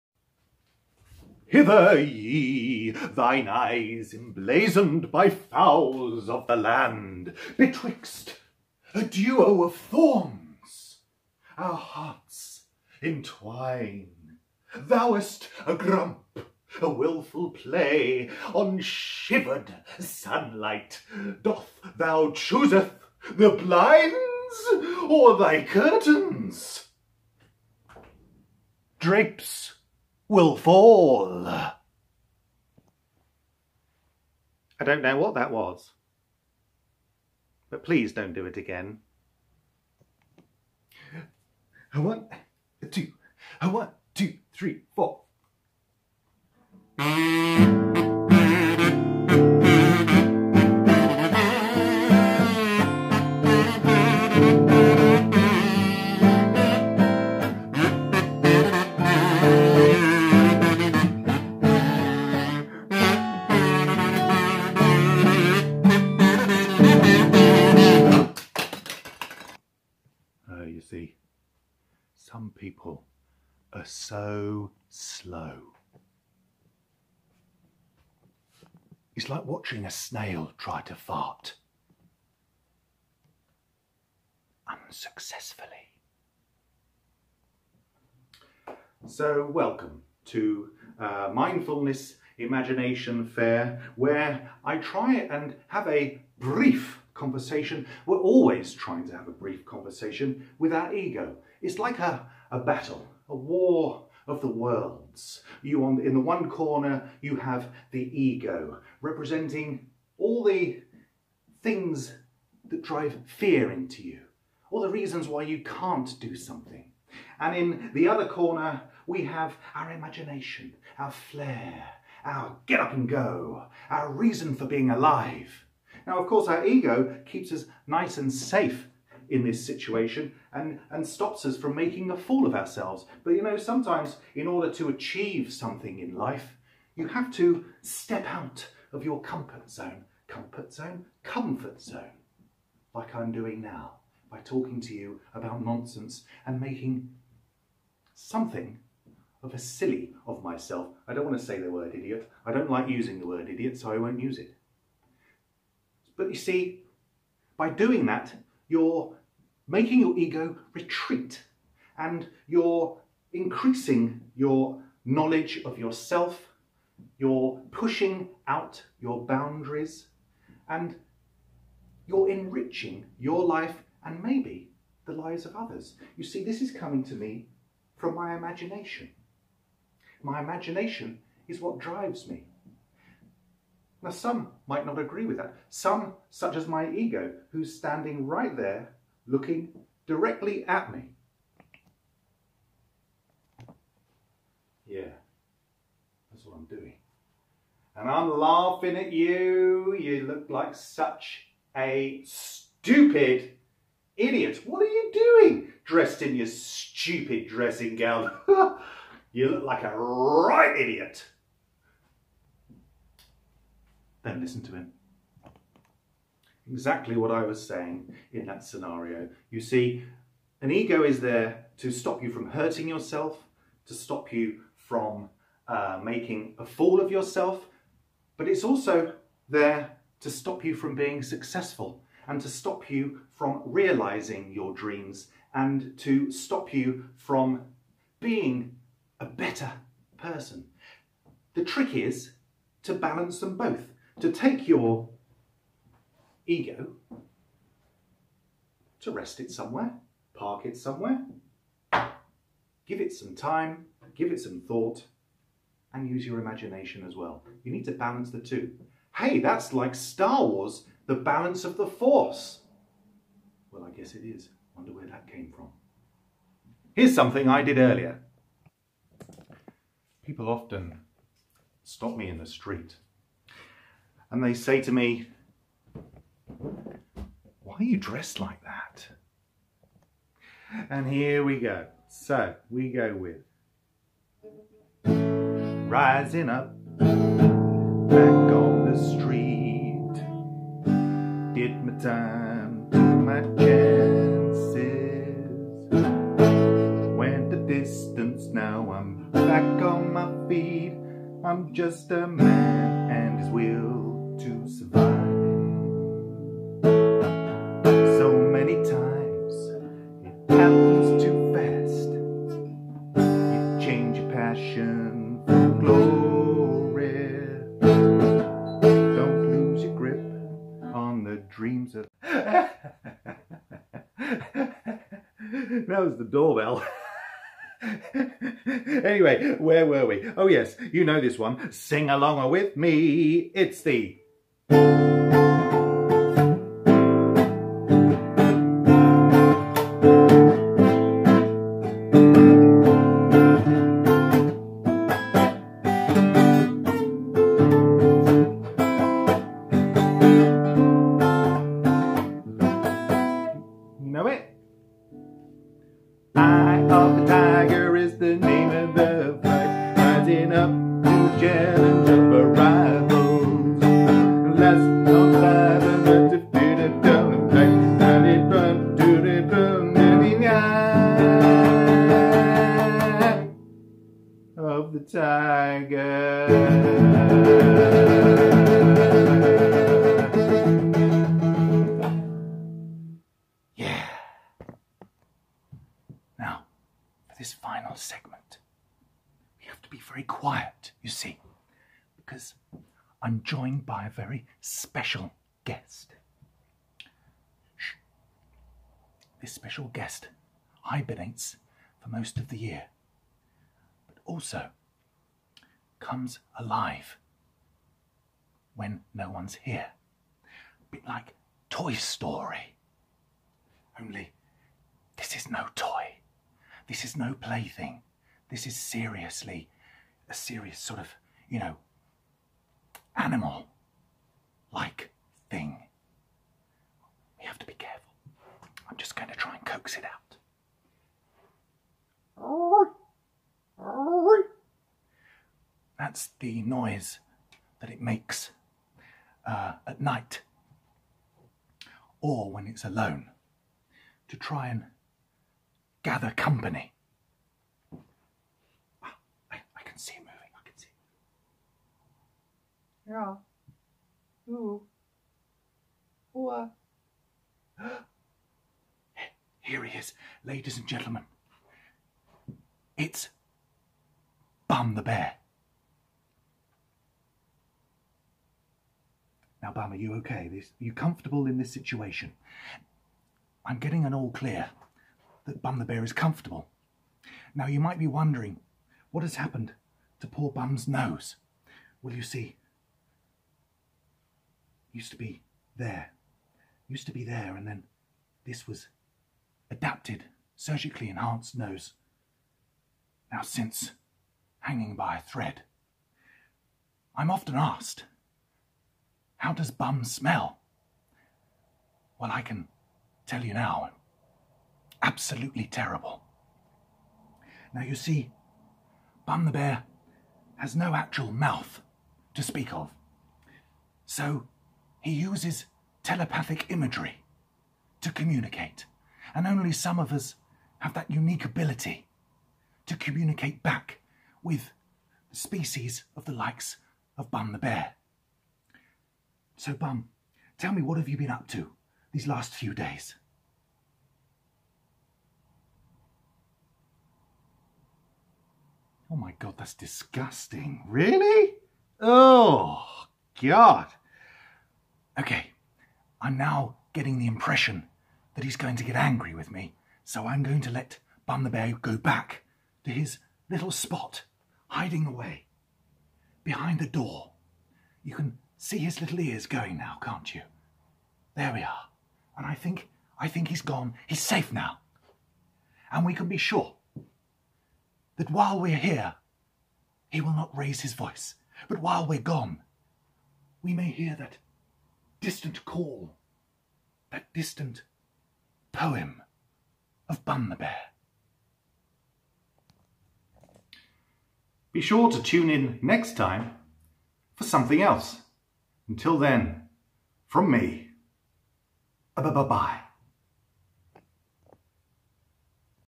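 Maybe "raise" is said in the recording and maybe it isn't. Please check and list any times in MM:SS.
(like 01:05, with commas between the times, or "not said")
09:30.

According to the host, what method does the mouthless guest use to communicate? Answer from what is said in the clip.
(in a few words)
Telepathic imagery.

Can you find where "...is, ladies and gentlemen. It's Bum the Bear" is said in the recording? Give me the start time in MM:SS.
07:39.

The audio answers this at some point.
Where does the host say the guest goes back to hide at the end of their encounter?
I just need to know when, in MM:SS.
09:16.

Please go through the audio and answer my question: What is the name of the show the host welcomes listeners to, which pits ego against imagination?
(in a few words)
Mindfulness Imagination Fair.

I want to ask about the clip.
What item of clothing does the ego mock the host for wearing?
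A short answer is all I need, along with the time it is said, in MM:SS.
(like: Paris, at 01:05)
Dressing gown, at 03:27.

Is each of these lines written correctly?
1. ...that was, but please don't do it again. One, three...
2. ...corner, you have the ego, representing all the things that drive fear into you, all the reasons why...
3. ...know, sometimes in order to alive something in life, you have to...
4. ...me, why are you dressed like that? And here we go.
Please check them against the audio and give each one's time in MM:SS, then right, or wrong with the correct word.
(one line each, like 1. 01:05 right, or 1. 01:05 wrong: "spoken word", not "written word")
1. 00:35 wrong: "two", not "three"
2. 01:46 right
3. 02:13 wrong: "achieve", not "alive"
4. 04:34 right.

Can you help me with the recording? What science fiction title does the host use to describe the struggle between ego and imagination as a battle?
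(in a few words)
War of the Worlds.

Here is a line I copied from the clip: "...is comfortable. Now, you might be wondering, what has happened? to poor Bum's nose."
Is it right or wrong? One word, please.
right.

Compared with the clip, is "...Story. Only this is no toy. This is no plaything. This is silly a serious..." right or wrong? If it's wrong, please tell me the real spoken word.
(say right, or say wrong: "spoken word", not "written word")
wrong: "seriously", not "silly".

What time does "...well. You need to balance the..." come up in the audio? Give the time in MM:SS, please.
04:17.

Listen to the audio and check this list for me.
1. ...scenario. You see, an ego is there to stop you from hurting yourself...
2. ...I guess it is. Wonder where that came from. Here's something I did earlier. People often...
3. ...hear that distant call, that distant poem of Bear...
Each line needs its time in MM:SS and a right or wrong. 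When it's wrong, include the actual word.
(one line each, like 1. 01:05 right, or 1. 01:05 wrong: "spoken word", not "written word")
1. 03:38 right
2. 04:23 right
3. 09:33 wrong: "Bun", not "Bear".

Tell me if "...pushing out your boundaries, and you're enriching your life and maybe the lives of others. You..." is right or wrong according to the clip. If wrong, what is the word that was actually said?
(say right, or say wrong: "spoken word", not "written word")
right.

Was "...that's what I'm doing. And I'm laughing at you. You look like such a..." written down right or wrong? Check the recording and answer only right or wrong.
right.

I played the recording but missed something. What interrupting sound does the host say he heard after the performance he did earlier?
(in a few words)
The doorbell.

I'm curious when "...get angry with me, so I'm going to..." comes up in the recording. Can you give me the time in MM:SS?
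09:08.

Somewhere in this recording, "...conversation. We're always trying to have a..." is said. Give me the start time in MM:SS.
01:37.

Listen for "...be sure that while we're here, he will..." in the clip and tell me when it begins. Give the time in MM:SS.
09:26.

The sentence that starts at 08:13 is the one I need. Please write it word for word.
Now, since hanging by a thread, I'm often asked, how does bum smell?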